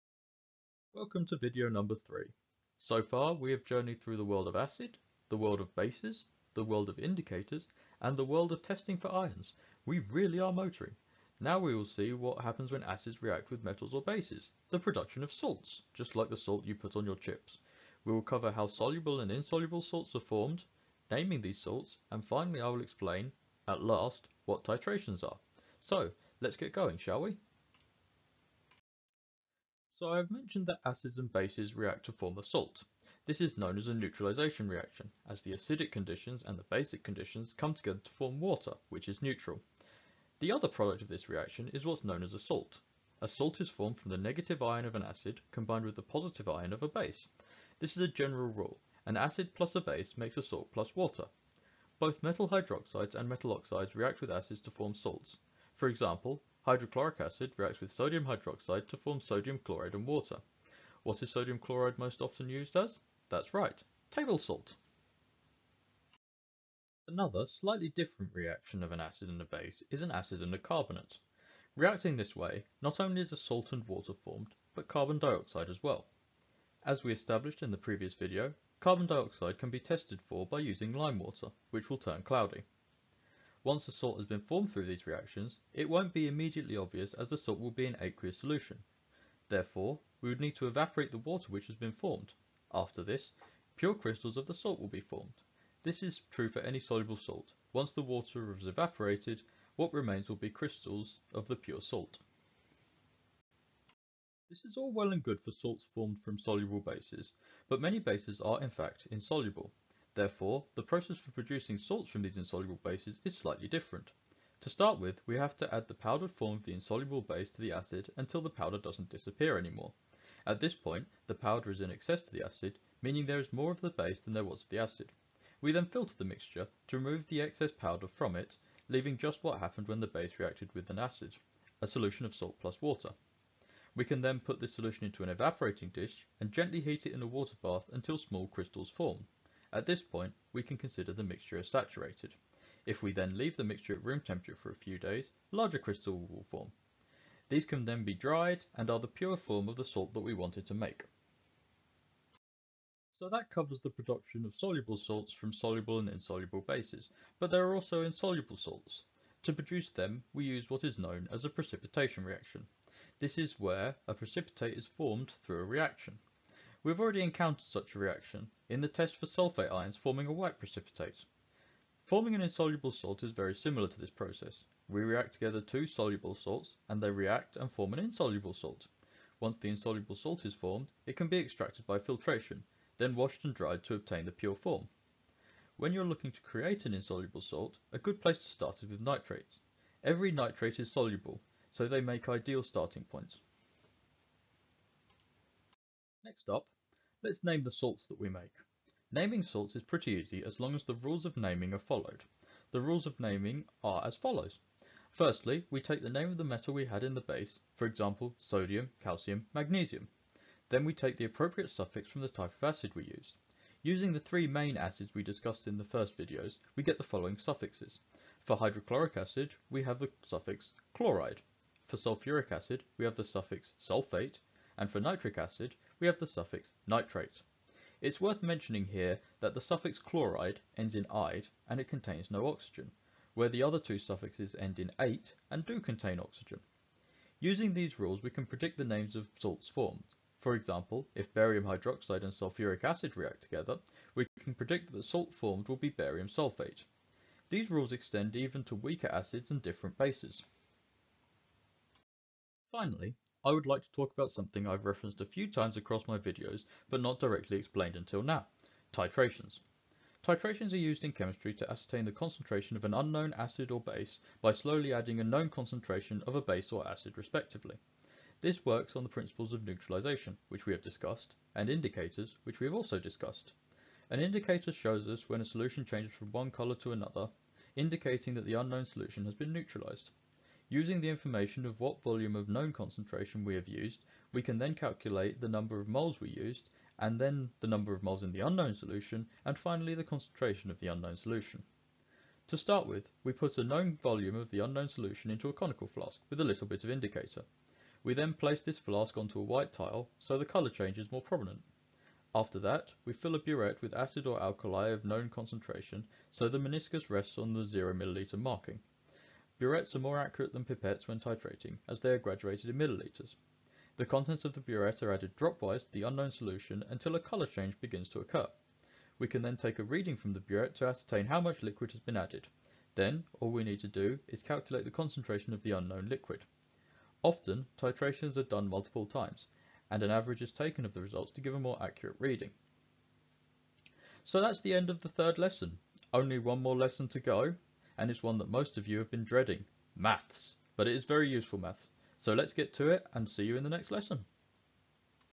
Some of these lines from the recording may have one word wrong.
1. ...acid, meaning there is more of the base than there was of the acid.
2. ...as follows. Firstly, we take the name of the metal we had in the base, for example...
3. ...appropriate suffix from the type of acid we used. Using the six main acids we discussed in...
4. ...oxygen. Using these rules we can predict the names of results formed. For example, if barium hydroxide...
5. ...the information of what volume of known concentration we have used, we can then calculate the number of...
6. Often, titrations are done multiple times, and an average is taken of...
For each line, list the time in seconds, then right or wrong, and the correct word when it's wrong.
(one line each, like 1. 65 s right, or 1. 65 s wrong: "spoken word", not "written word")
1. 122 s right
2. 204 s right
3. 211 s wrong: "three", not "six"
4. 236 s wrong: "salts", not "results"
5. 281 s right
6. 327 s right.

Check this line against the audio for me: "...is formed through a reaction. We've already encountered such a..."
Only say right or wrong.
right.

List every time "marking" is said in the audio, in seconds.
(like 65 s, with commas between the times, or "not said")
308 s.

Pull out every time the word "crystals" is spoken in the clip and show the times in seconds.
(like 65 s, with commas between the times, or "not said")
93 s, 100 s, 138 s, 145 s.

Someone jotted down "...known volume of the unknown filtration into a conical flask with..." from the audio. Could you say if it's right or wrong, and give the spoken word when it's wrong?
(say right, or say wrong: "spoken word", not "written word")
wrong: "solution", not "filtration".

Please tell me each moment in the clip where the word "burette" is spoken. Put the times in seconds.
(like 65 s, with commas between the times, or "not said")
303 s, 309 s, 314 s, 320 s.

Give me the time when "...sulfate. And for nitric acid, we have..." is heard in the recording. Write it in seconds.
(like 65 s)
223 s.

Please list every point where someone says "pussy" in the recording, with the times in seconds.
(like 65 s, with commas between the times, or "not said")
not said.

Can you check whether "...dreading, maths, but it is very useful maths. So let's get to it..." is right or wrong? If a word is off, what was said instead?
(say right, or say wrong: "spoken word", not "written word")
right.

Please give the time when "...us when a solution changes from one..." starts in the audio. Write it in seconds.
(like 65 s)
275 s.